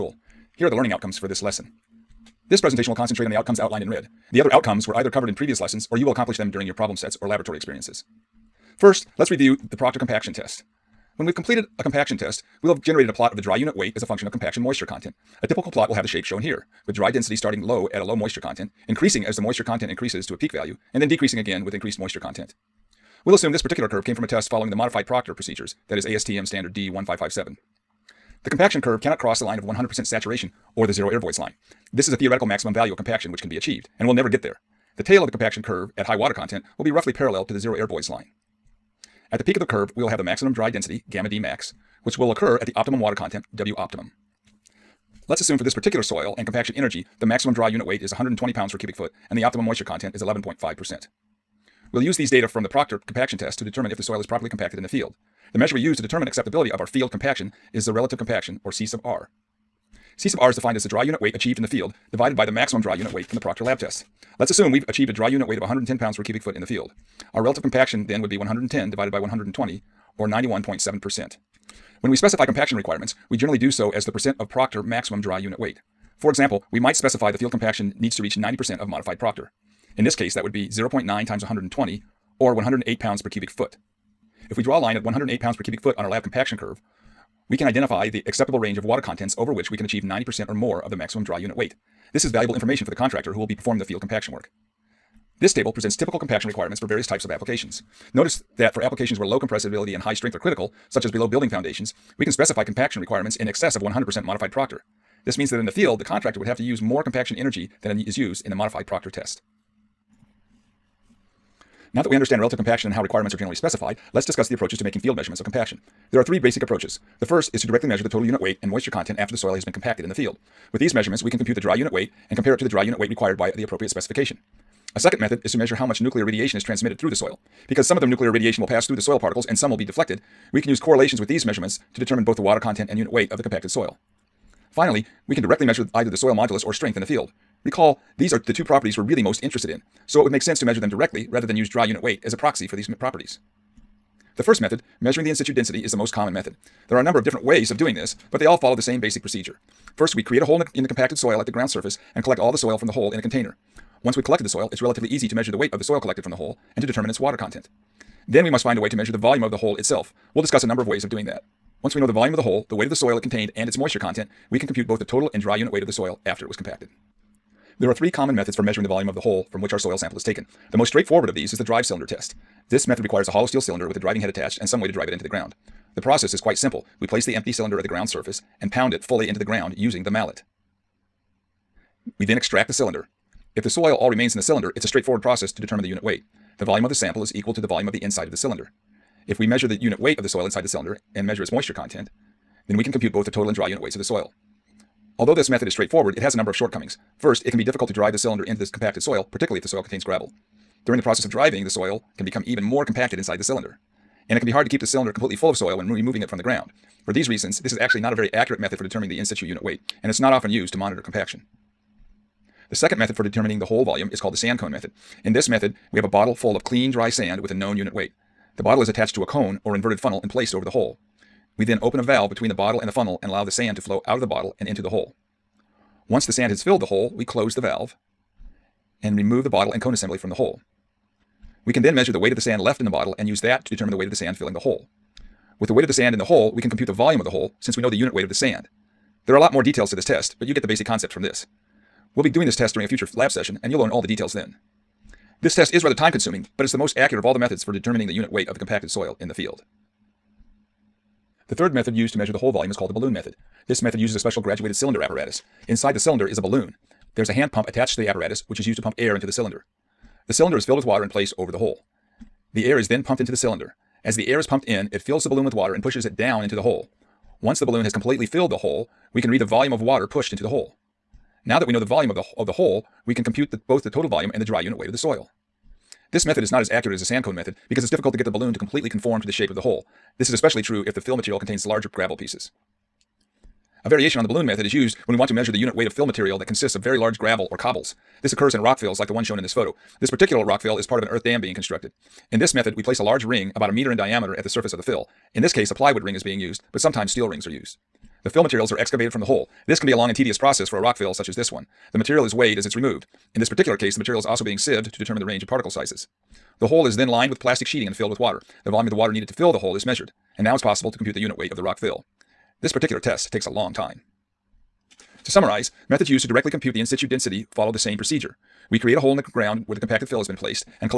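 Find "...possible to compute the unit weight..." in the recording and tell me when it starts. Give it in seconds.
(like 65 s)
310 s.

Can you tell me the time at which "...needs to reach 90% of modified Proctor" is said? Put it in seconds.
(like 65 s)
77 s.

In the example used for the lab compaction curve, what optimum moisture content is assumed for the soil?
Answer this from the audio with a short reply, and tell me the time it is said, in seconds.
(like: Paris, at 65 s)
11.5%, at 50 s.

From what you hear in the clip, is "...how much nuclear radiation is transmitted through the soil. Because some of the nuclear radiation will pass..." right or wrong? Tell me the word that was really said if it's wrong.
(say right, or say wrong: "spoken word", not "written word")
right.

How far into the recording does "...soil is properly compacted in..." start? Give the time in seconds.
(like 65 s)
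54 s.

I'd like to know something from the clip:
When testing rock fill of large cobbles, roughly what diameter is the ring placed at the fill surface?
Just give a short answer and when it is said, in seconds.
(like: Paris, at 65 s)
about a meter, at 293 s.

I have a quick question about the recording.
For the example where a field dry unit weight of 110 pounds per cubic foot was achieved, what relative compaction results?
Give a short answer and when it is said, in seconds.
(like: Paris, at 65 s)
91.7%, at 70 s.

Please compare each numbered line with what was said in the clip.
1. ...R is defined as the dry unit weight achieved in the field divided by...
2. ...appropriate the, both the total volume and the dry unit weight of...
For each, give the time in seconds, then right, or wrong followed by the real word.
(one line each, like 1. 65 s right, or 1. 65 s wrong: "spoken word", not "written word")
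1. 60 s right
2. 273 s wrong: "compute", not "appropriate".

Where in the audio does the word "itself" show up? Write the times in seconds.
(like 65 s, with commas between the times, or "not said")
159 s.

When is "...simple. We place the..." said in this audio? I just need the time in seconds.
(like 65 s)
176 s.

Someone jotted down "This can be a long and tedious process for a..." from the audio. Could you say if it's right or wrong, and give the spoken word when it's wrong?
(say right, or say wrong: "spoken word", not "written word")
right.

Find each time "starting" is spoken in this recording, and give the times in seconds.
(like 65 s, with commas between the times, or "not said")
17 s.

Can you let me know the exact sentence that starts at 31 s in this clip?
This is a theoretical maximum value of compaction which can be achieved, and will never get there.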